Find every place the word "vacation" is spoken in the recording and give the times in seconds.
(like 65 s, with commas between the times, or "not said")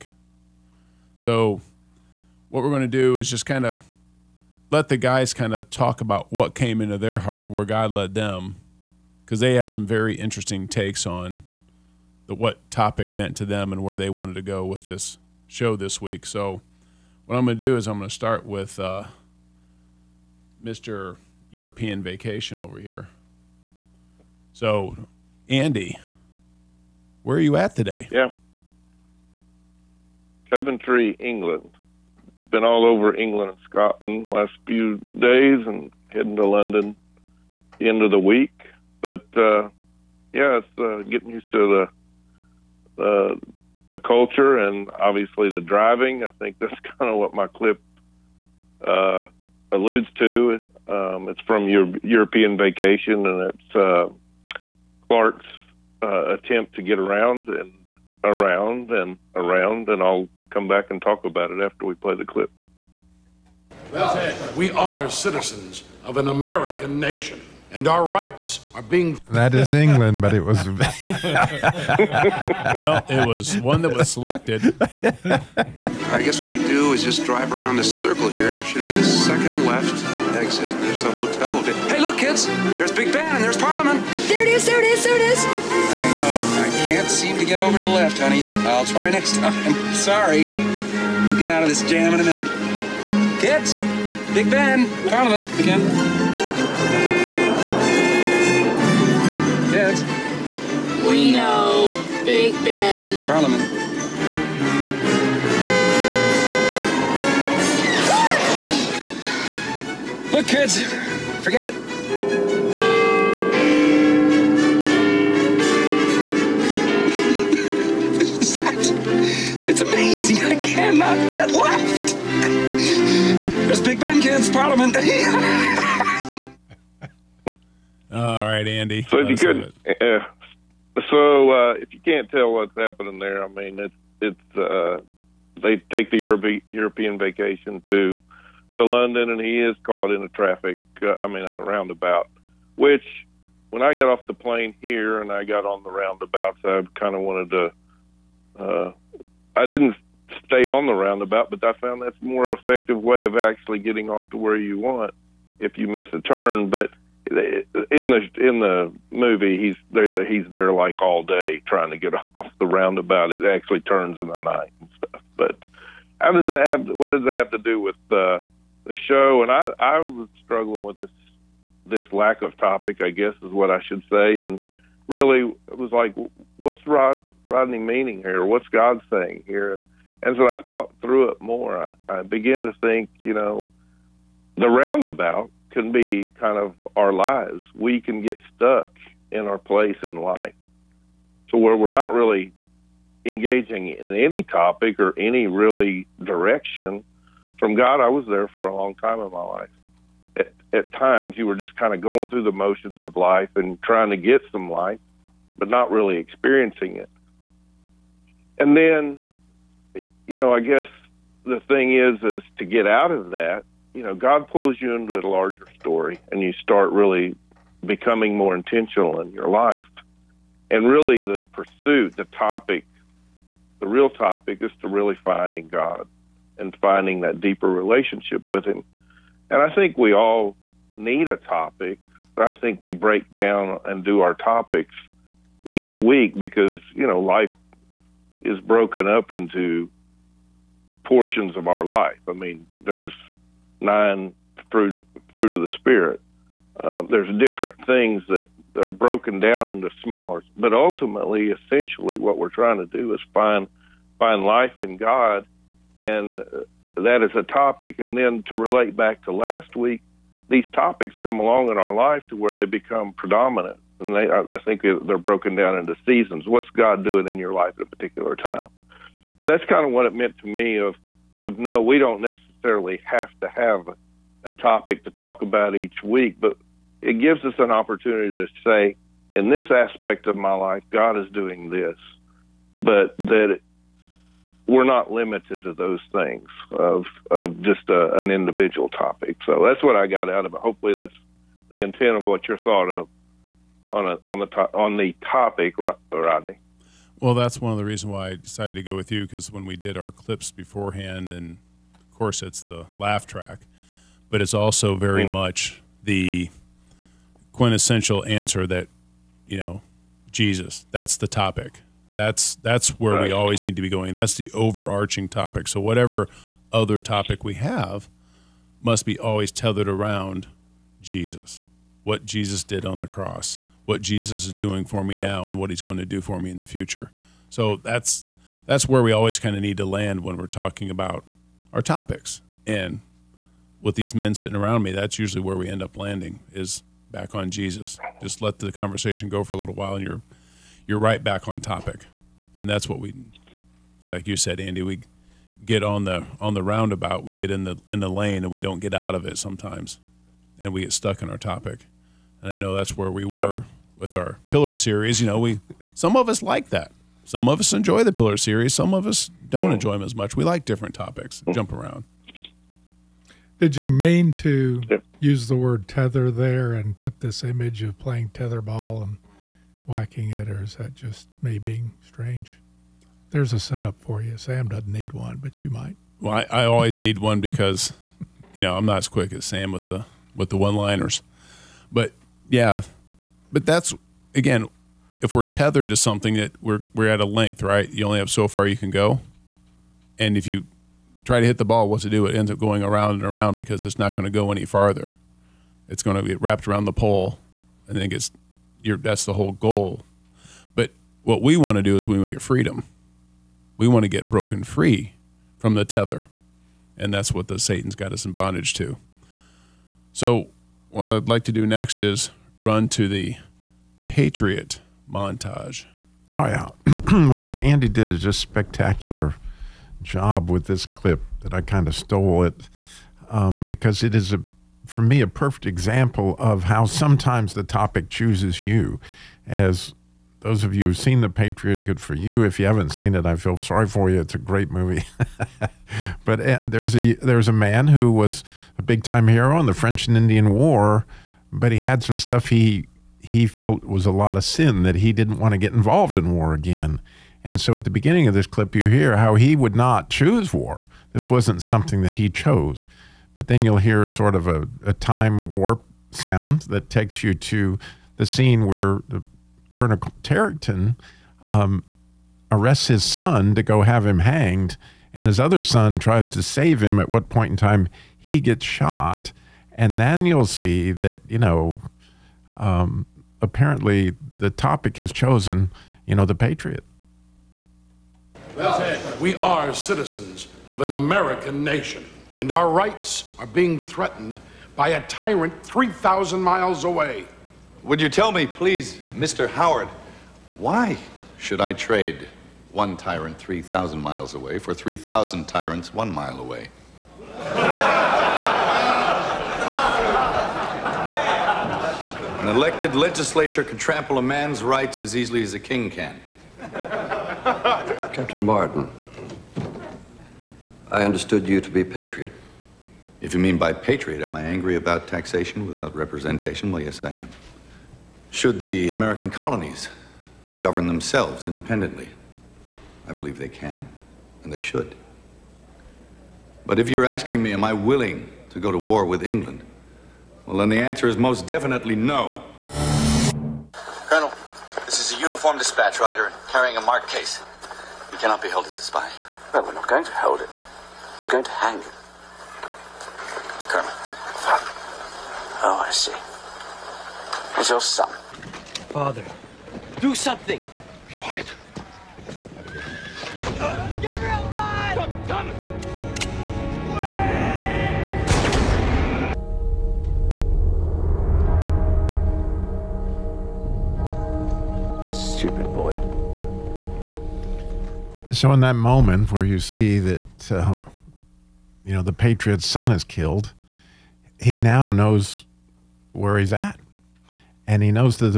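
22 s, 52 s, 137 s.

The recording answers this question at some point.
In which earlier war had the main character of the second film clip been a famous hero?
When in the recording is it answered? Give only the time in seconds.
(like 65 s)
439 s.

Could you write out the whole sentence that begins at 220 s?
And really, the pursuit, the topic, the real topic is to really finding God and finding that deeper relationship with Him.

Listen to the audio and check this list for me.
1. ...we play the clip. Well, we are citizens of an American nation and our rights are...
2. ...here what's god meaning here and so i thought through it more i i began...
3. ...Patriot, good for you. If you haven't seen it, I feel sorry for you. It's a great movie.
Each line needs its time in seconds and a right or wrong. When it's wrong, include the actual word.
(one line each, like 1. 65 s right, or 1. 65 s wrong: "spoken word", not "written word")
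1. 61 s right
2. 178 s wrong: "saying", not "meaning"
3. 431 s right.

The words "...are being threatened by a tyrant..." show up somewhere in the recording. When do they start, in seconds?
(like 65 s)
483 s.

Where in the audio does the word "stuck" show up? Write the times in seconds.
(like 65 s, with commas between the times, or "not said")
188 s, 350 s.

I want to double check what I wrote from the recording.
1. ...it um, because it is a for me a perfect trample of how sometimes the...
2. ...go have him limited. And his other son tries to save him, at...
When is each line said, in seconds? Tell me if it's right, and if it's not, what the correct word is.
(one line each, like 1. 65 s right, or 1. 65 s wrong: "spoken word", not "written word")
1. 422 s wrong: "example", not "trample"
2. 463 s wrong: "hanged", not "limited".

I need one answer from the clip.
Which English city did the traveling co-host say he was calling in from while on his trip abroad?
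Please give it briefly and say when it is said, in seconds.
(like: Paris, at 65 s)
Coventry, at 30 s.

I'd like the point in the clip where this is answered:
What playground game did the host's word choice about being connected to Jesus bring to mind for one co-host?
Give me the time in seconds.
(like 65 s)
368 s.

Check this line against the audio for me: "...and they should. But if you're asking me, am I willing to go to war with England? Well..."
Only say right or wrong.
right.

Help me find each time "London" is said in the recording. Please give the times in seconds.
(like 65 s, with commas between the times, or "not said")
36 s, 138 s.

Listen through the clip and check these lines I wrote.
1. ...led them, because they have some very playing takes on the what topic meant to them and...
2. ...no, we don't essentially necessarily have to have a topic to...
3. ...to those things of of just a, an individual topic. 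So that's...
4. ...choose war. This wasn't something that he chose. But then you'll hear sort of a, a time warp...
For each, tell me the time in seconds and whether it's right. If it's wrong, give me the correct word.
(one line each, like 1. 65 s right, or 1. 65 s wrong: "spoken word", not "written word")
1. 7 s wrong: "interesting", not "playing"
2. 271 s wrong: "necessarily", not "essentially"
3. 285 s right
4. 450 s right.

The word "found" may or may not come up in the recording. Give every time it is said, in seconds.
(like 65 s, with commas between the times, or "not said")
151 s.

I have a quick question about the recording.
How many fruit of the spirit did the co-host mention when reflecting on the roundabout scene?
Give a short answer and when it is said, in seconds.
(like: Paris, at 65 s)
9, at 243 s.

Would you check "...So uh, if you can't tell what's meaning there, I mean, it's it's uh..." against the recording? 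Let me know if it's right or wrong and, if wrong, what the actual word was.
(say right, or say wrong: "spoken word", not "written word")
wrong: "happening", not "meaning".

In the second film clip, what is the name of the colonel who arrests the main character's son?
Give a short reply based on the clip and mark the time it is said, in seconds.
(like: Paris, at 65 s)
Colonel Tavington, at 459 s.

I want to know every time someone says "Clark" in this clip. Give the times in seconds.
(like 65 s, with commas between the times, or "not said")
55 s.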